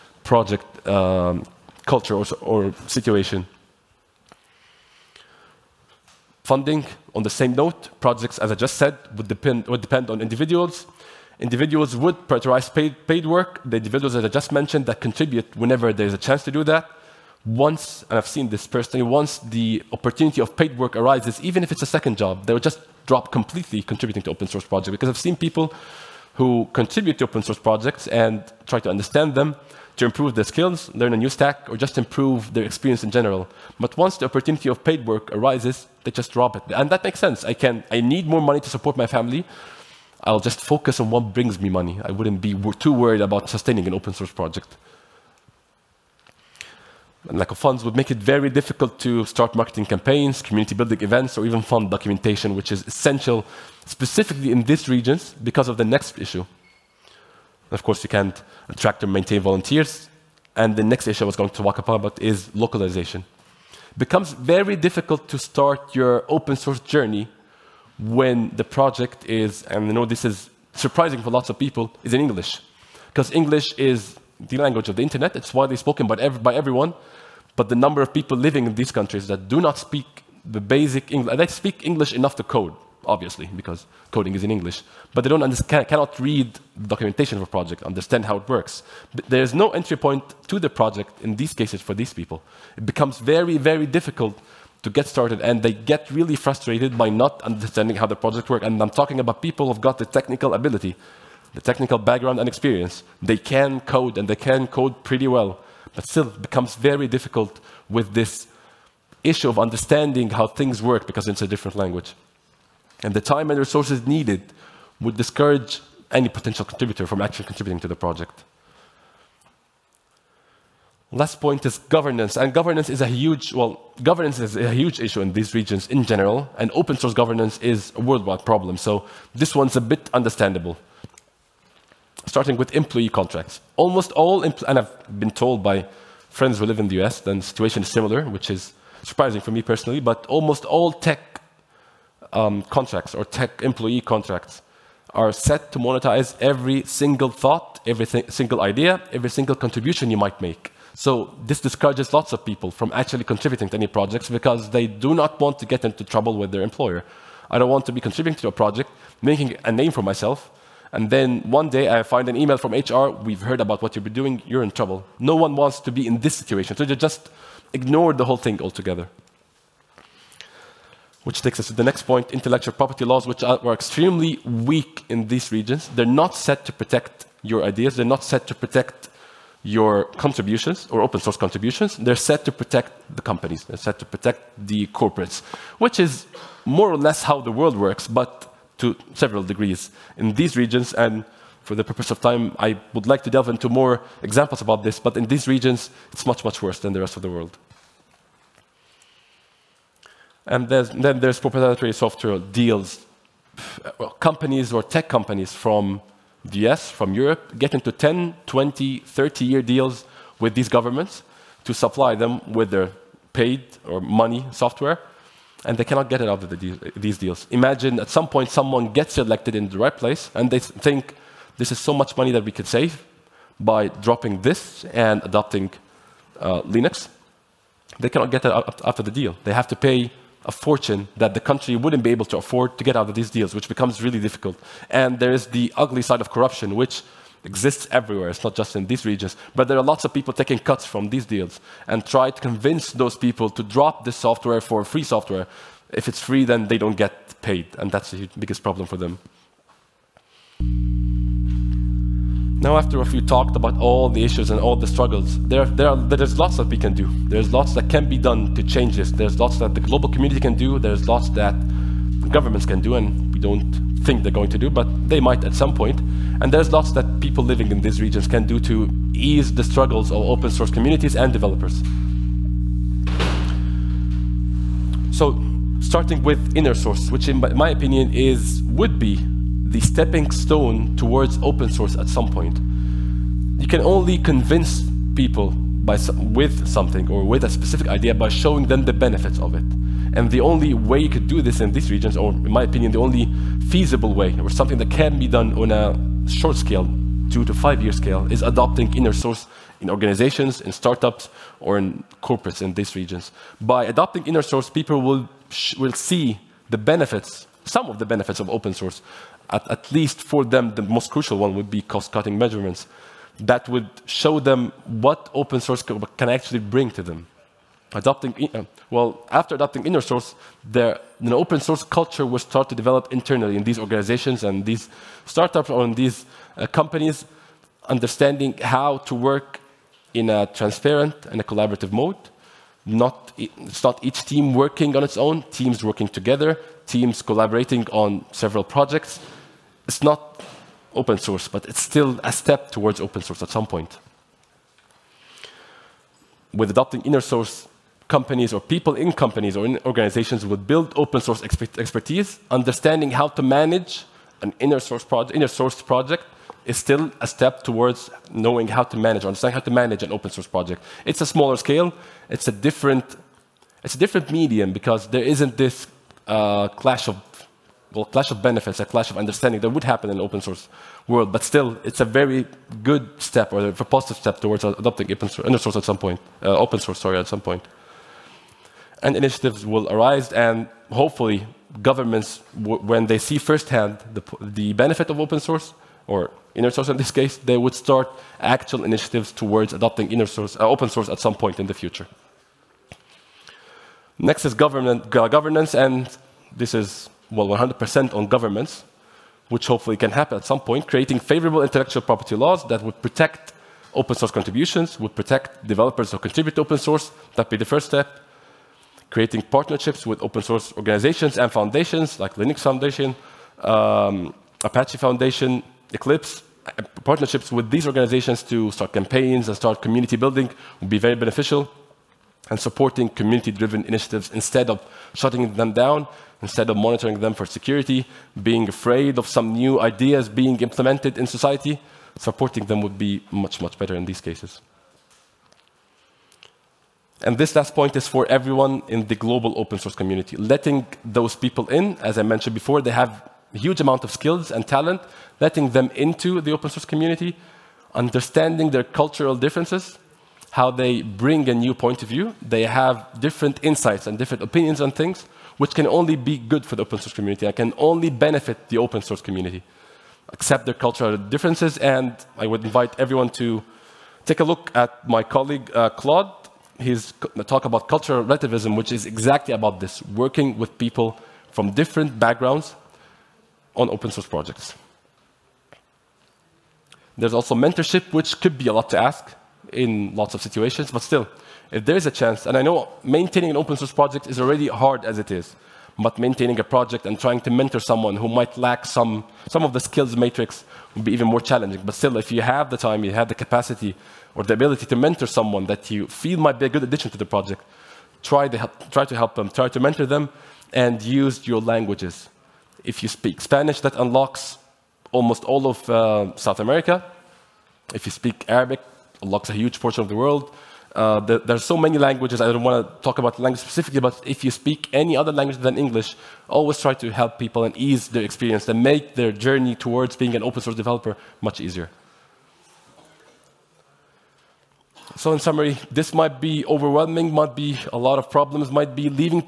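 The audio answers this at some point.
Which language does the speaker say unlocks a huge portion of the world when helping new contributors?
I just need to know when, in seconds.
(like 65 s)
508 s.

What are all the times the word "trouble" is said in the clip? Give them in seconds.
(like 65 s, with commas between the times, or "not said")
156 s, 164 s.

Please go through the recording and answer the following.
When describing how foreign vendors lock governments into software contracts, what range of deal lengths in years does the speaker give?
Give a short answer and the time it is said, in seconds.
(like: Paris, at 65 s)
10, 20, 30-year, at 207 s.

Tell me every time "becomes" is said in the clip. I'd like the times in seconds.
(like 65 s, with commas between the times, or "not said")
63 s, 92 s, 106 s, 233 s.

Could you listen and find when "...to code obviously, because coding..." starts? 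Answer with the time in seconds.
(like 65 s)
82 s.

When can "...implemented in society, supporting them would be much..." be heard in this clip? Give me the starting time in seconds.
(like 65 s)
430 s.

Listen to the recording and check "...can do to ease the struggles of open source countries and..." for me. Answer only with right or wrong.
wrong.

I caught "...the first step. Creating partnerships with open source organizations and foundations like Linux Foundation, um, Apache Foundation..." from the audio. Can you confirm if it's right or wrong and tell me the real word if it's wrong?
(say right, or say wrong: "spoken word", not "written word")
right.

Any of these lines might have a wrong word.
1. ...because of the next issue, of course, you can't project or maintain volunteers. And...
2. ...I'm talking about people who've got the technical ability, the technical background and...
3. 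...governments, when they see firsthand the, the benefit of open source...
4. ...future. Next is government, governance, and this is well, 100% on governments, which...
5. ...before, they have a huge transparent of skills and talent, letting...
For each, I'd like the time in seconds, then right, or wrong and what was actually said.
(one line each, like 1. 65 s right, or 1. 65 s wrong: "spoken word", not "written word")
1. 55 s wrong: "attract", not "project"
2. 98 s right
3. 381 s right
4. 391 s right
5. 442 s wrong: "amount", not "transparent".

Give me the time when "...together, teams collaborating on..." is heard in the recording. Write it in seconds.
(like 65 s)
336 s.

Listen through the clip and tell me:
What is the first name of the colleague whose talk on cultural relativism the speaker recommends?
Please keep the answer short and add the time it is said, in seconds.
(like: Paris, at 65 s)
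Claude, at 465 s.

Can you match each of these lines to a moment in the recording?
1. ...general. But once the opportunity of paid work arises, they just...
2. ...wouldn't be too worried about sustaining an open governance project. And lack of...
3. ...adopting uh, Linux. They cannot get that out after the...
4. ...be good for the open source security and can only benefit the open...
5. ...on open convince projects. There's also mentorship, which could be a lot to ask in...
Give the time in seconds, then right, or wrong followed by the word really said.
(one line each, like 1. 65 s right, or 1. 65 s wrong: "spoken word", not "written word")
1. 33 s right
2. 42 s wrong: "source", not "governance"
3. 225 s right
4. 456 s wrong: "community", not "security"
5. 473 s wrong: "source", not "convince".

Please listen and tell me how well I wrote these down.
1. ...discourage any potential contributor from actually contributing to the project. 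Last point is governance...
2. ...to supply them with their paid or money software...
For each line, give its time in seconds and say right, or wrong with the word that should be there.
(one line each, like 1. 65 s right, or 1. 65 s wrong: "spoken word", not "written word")
1. 115 s right
2. 211 s right.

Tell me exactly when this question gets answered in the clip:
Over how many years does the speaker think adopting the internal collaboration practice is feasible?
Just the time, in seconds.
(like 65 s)
297 s.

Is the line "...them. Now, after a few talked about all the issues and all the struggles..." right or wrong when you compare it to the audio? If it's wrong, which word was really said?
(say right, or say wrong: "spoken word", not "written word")
right.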